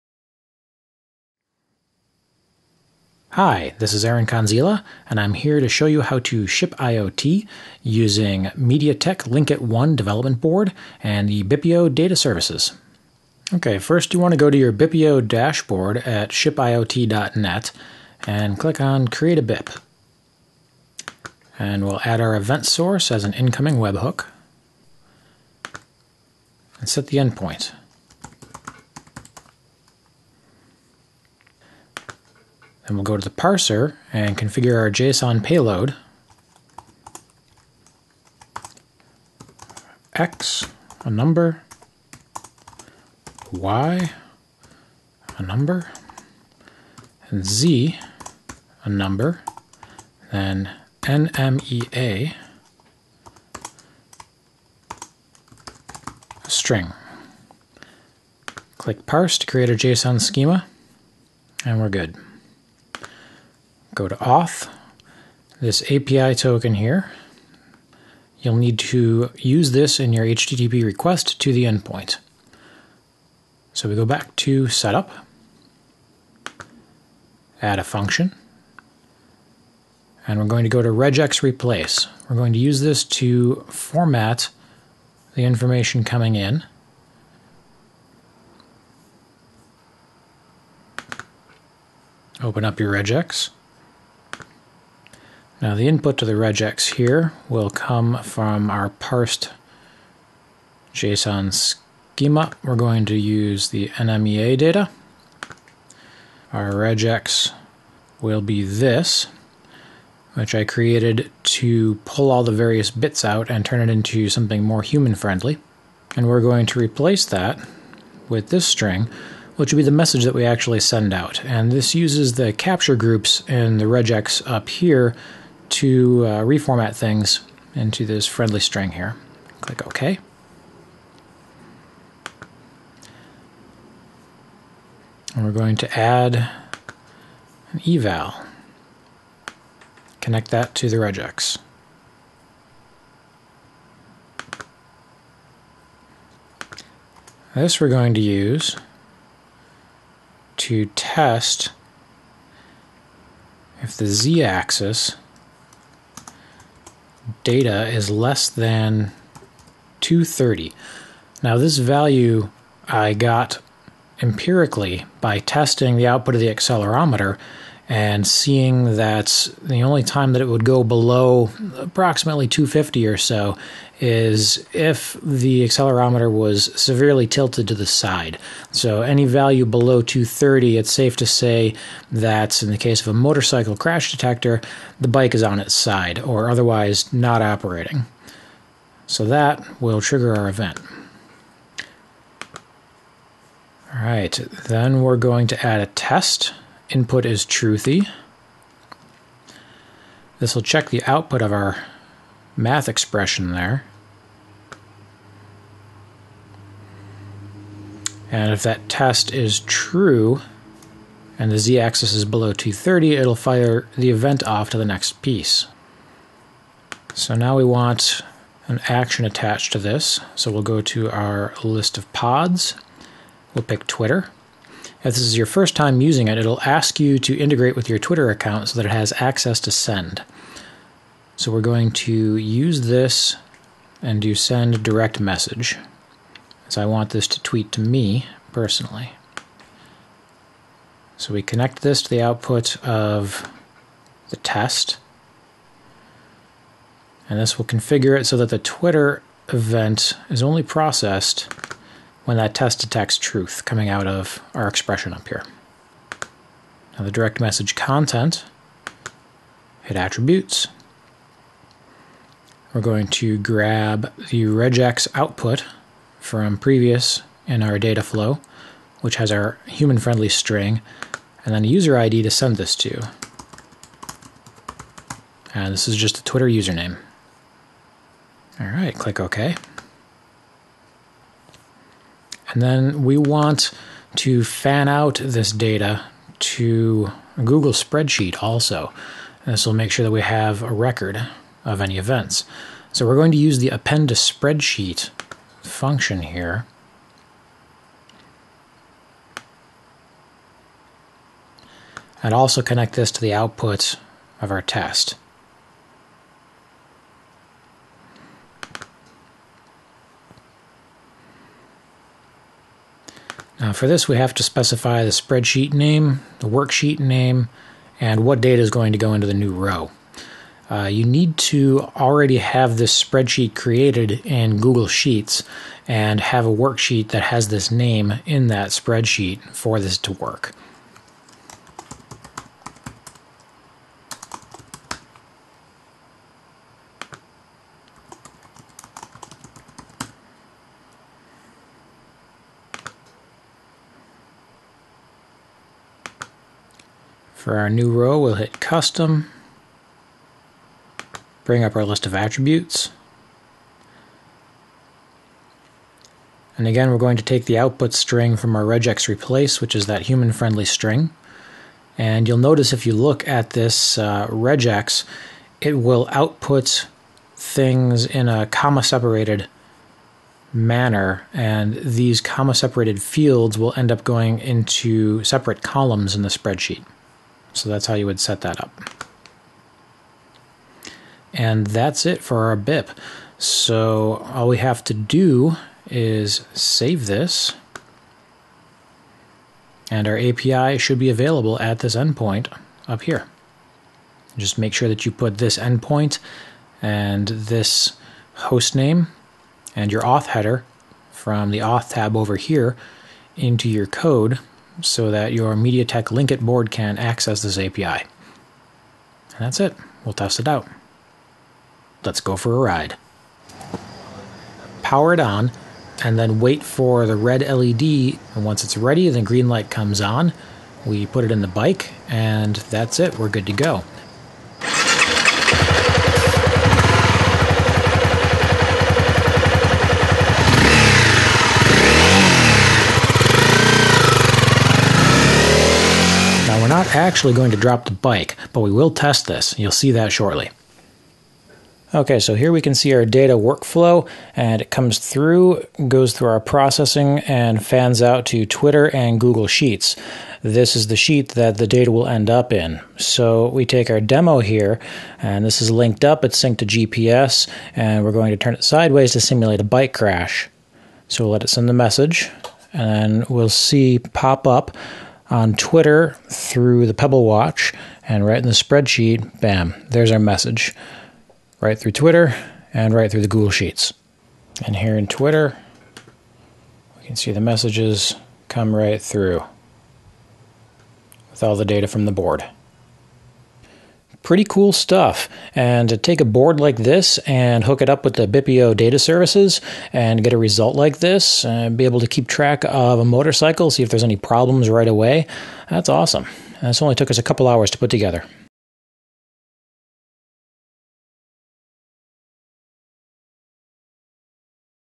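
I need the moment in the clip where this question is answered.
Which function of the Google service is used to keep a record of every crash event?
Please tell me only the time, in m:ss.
4:53.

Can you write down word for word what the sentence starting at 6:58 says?
And once it's ready, the green light comes on.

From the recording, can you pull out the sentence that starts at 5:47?
For our new row, we'll hit Custom, bring up our list of attributes.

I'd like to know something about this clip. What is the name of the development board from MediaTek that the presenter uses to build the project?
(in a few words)
Linkit 1.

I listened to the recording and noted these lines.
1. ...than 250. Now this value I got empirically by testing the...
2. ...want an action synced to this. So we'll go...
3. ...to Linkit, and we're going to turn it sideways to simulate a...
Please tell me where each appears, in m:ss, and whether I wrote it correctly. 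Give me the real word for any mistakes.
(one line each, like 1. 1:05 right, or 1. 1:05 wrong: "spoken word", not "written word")
1. 2:38 wrong: "230", not "250"
2. 3:37 wrong: "attached", not "synced"
3. 7:36 wrong: "GPS", not "Linkit".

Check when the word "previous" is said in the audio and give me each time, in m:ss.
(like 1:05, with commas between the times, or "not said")
4:26.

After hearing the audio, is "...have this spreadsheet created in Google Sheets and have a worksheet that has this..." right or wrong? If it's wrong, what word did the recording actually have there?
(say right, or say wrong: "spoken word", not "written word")
right.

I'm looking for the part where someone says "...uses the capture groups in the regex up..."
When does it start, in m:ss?
2:01.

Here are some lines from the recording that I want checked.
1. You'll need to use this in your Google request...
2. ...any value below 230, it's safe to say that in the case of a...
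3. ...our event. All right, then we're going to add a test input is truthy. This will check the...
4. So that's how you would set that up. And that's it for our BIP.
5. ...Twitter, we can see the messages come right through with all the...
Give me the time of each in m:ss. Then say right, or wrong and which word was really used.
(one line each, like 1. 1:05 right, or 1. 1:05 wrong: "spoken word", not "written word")
1. 1:08 wrong: "HTTP", not "Google"
2. 2:59 right
3. 3:10 right
4. 6:17 right
5. 7:55 right.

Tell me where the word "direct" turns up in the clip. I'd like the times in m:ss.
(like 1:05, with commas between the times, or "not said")
3:54, 4:17.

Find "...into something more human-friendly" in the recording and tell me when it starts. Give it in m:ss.
1:53.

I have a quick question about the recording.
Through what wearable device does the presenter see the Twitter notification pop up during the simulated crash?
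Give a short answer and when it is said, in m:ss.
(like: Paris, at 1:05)
Pebble Watch, at 7:46.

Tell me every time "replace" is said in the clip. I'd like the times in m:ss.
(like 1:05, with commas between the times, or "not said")
1:21, 1:56, 5:59.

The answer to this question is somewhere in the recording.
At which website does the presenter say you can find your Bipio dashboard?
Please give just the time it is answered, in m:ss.
0:16.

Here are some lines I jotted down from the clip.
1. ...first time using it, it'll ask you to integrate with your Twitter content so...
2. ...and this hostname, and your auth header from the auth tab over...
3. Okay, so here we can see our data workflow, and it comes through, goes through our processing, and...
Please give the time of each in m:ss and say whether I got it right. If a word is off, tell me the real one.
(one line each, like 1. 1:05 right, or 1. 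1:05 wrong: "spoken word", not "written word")
1. 3:45 wrong: "account", not "content"
2. 6:36 right
3. 7:21 right.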